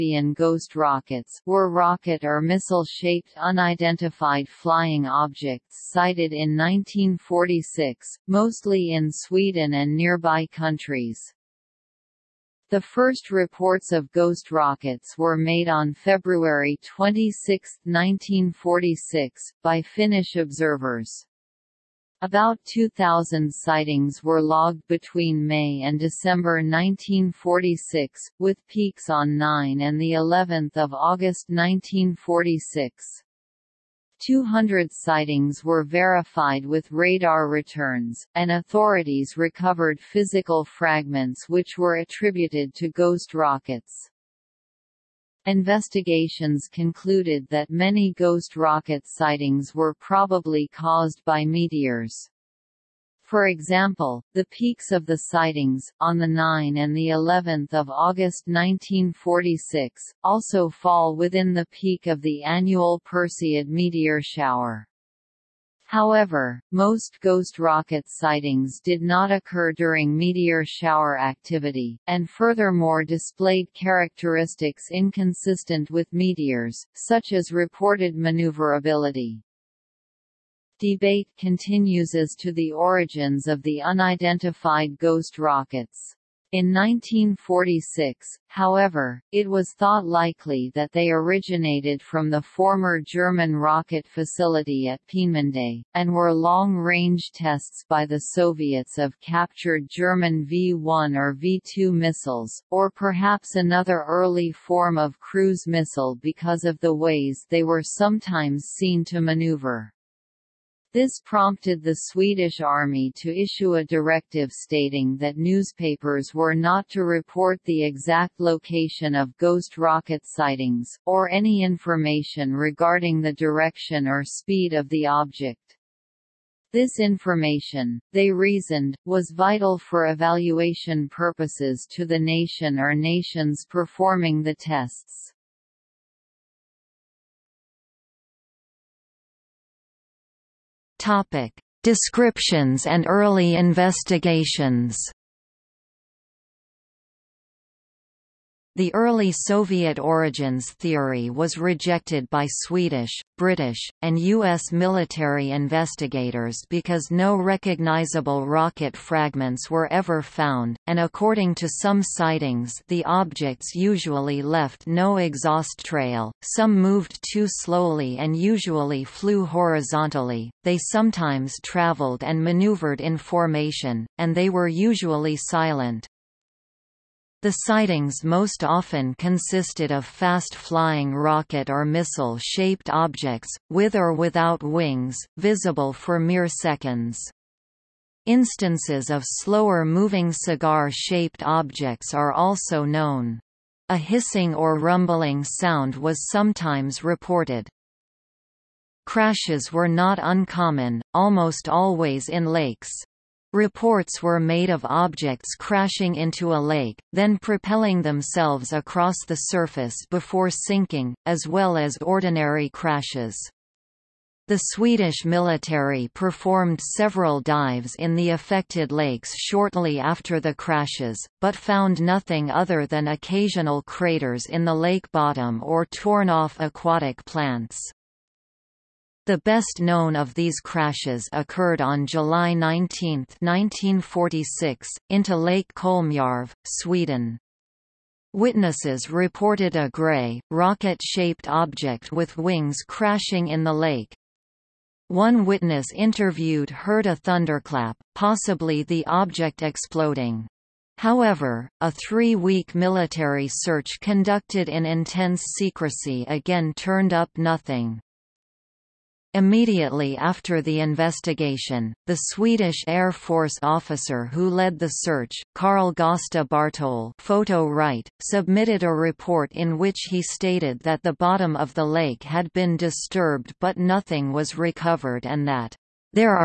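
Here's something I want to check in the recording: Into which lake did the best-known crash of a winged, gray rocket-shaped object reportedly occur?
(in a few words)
Lake Kolmjärv.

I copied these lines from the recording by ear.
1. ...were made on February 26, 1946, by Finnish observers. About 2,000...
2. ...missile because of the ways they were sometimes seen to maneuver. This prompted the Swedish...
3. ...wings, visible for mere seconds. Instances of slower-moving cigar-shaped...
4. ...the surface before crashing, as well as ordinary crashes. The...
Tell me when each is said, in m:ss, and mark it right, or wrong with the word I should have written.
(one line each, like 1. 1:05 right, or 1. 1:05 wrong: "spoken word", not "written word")
1. 0:15 right
2. 1:45 right
3. 3:04 right
4. 3:29 wrong: "sinking", not "crashing".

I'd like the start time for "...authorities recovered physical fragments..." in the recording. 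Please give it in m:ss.
0:38.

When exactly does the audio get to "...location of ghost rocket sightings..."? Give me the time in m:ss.
1:58.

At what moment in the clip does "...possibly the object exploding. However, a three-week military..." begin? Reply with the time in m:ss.
4:08.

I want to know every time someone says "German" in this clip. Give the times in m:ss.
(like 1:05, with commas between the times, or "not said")
1:33, 1:39.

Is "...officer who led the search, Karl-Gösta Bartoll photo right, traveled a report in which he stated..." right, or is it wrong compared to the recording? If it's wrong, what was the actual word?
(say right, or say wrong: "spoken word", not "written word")
wrong: "submitted", not "traveled".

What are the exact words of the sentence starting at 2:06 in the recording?
This information, they reasoned, was vital for evaluation purposes to the nation or nations performing the tests.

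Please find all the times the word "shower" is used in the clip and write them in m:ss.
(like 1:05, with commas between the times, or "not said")
1:04, 1:10.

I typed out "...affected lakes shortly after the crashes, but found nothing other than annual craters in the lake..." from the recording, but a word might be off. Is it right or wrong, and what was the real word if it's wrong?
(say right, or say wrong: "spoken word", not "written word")
wrong: "occasional", not "annual".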